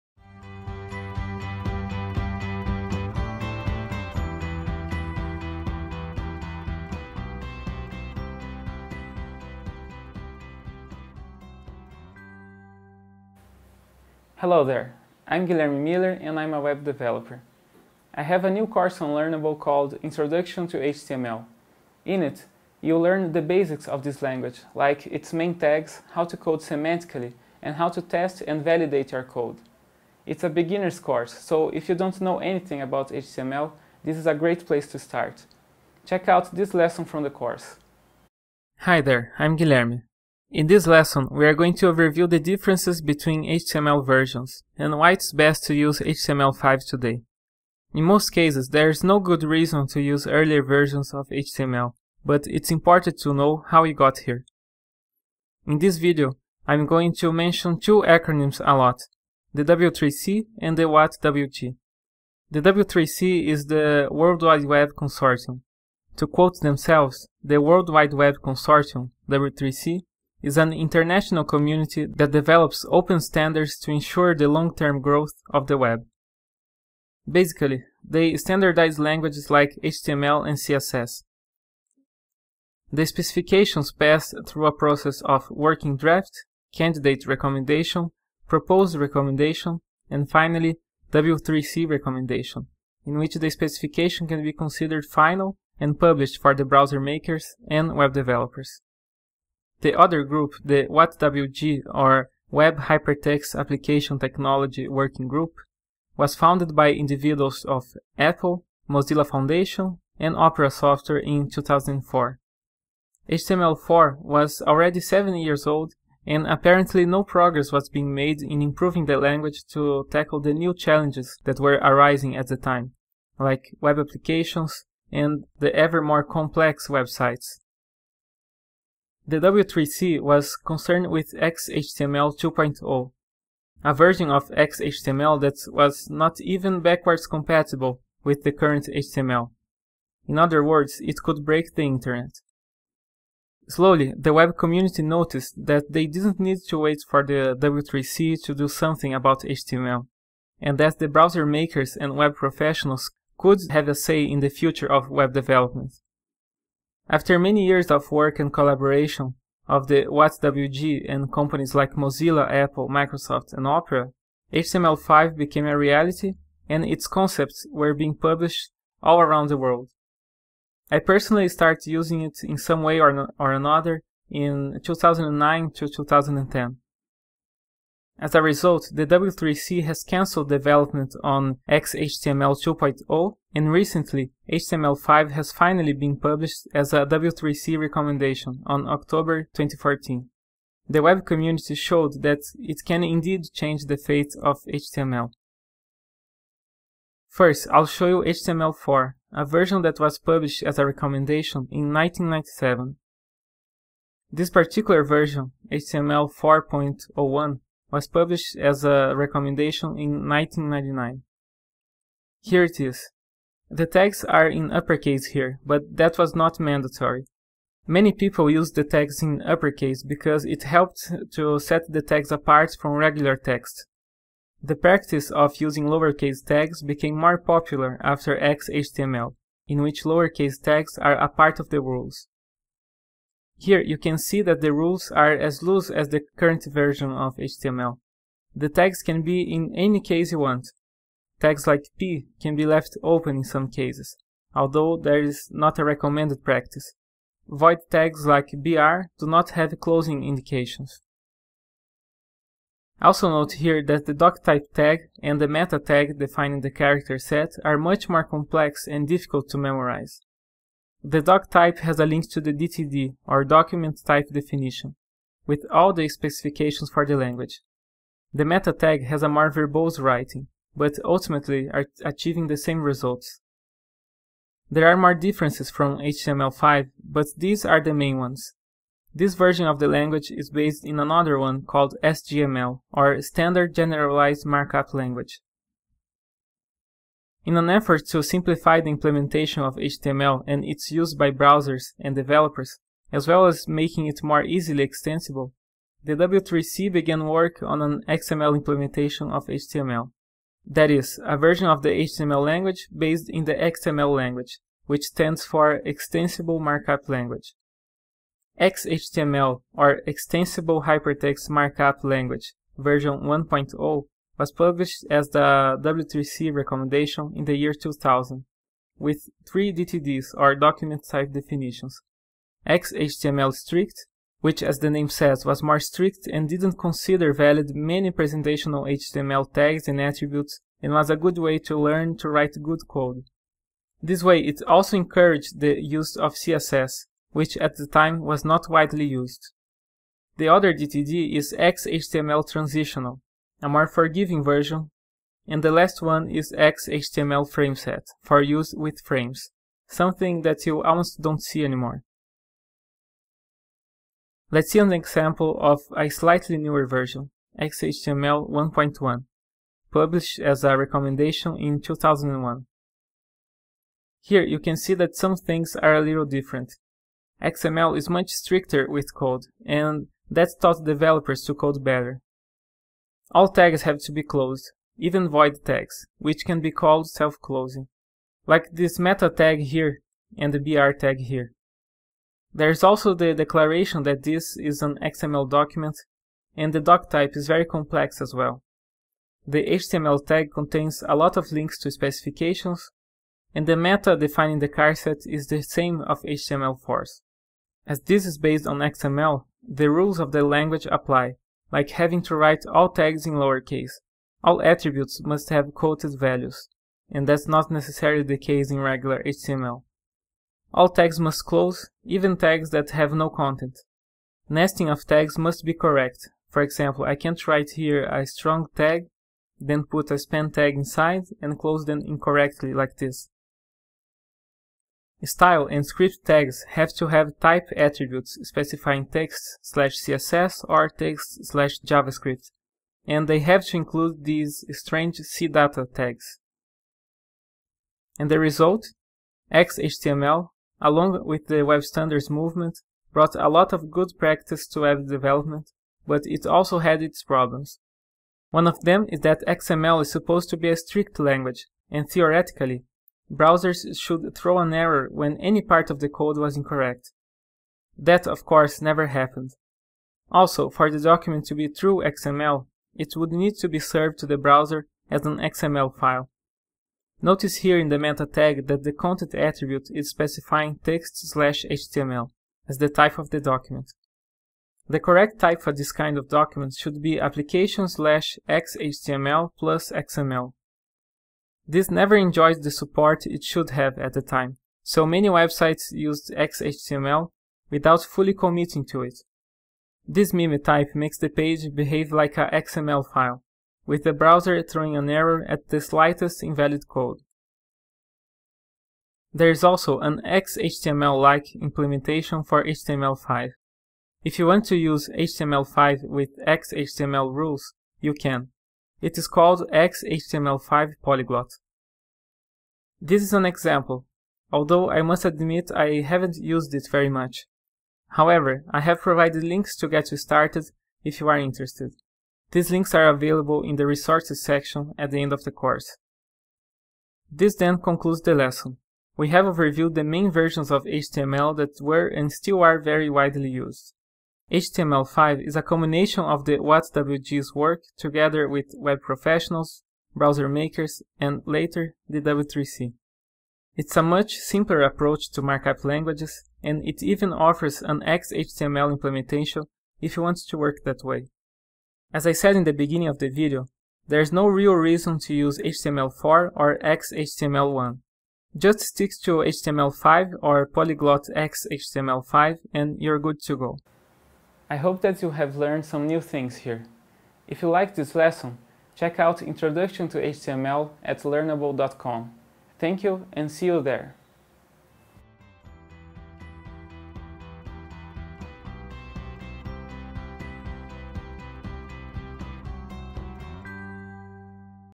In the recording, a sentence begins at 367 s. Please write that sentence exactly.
XML is much stricter with code, and that taught developers to code better.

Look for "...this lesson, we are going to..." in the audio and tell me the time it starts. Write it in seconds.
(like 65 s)
40 s.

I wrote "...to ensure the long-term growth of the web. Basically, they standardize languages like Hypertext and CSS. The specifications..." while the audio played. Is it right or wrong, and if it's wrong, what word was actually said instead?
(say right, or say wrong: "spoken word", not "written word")
wrong: "HTML", not "Hypertext".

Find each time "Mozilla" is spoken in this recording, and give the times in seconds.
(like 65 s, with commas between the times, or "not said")
108 s, 161 s.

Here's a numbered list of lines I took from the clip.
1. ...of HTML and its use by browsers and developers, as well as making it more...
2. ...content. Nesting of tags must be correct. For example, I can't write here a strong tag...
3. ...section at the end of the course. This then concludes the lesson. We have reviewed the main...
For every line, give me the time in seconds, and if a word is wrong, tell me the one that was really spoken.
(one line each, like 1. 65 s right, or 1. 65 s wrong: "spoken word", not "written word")
1. 289 s right
2. 413 s right
3. 524 s right.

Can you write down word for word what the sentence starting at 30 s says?
It's a beginner's course, so if you don't know anything about HTML, this is a great place to start.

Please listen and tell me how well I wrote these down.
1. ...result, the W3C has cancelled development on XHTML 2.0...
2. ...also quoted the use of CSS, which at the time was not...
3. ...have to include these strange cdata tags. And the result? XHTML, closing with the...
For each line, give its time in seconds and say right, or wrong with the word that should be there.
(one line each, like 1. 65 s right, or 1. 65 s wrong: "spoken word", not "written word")
1. 178 s right
2. 334 s wrong: "encouraged", not "quoted"
3. 433 s wrong: "along", not "closing".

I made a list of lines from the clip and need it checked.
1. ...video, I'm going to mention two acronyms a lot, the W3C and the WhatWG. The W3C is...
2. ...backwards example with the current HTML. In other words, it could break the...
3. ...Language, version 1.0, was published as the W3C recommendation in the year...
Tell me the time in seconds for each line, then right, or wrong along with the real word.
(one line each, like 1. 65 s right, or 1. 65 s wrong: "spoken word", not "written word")
1. 55 s right
2. 136 s wrong: "compatible", not "example"
3. 312 s right.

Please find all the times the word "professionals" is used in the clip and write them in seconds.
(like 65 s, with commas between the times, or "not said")
152 s, 539 s.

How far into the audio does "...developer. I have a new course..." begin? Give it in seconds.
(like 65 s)
16 s.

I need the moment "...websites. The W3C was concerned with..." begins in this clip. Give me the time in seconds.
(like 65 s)
126 s.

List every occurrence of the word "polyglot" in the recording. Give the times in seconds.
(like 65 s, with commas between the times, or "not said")
511 s, 560 s.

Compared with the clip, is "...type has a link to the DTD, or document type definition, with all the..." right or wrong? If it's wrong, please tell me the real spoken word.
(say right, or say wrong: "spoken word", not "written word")
right.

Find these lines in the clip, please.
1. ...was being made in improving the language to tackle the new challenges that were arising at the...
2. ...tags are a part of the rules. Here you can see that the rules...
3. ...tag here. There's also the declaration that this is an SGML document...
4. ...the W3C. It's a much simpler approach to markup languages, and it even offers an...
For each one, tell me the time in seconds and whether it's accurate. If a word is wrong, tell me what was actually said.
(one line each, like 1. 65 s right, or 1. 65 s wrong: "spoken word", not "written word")
1. 117 s right
2. 230 s right
3. 380 s wrong: "XML", not "SGML"
4. 542 s right.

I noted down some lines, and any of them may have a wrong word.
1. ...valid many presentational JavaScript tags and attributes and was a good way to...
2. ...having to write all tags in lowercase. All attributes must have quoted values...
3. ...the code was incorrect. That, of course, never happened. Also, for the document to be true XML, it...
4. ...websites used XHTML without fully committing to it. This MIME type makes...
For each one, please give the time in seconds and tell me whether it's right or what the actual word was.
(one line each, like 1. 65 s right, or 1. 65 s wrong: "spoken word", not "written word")
1. 327 s wrong: "HTML", not "JavaScript"
2. 401 s right
3. 455 s right
4. 485 s right.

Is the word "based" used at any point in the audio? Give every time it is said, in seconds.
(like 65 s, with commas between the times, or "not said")
280 s, 302 s, 398 s.